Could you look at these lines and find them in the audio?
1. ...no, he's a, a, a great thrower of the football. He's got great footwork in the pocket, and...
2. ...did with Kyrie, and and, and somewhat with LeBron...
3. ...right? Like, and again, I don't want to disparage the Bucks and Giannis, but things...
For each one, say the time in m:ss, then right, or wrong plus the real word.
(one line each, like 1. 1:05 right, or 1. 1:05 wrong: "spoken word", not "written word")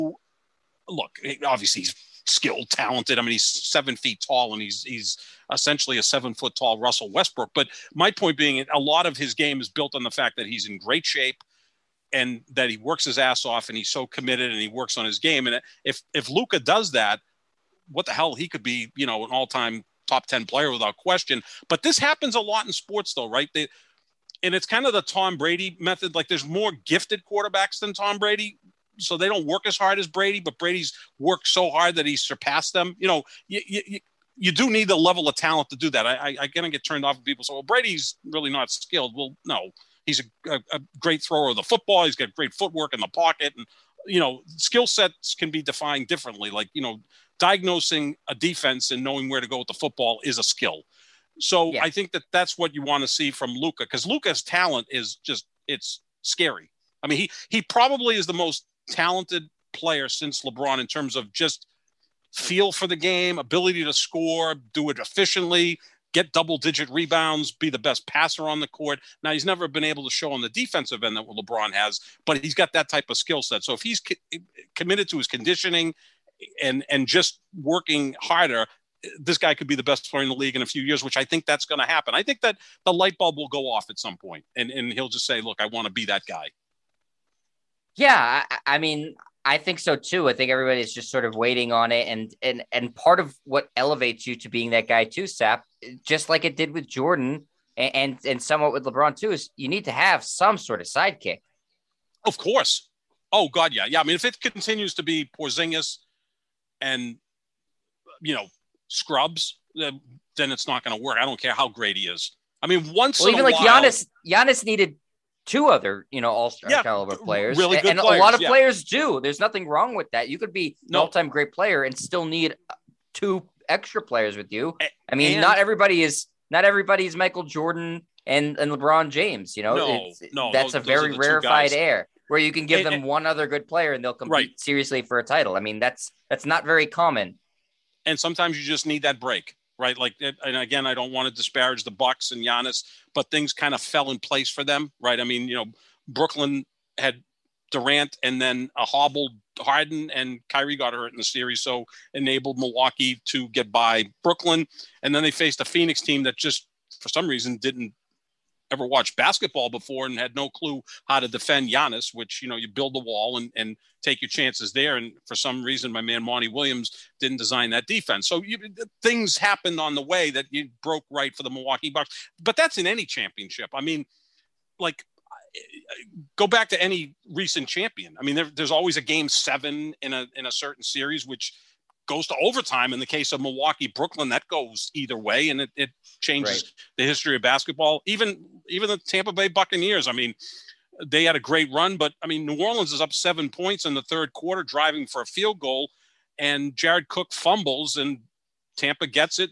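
1. 0:39 right
2. 1:36 wrong: "Jordan", not "Kyrie"
3. 2:19 right.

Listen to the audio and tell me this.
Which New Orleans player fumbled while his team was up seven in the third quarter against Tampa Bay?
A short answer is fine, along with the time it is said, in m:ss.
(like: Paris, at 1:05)
Jared Cook, at 3:16.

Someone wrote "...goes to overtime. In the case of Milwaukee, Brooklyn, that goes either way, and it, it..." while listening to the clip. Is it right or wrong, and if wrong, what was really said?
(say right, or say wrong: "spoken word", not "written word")
right.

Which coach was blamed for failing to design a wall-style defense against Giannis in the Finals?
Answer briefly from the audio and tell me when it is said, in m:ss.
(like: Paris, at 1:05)
Monty Williams, at 2:46.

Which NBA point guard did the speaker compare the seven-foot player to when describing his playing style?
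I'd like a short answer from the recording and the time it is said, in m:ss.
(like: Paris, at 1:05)
Russell Westbrook, at 0:06.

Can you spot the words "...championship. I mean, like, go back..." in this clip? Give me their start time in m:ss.
2:53.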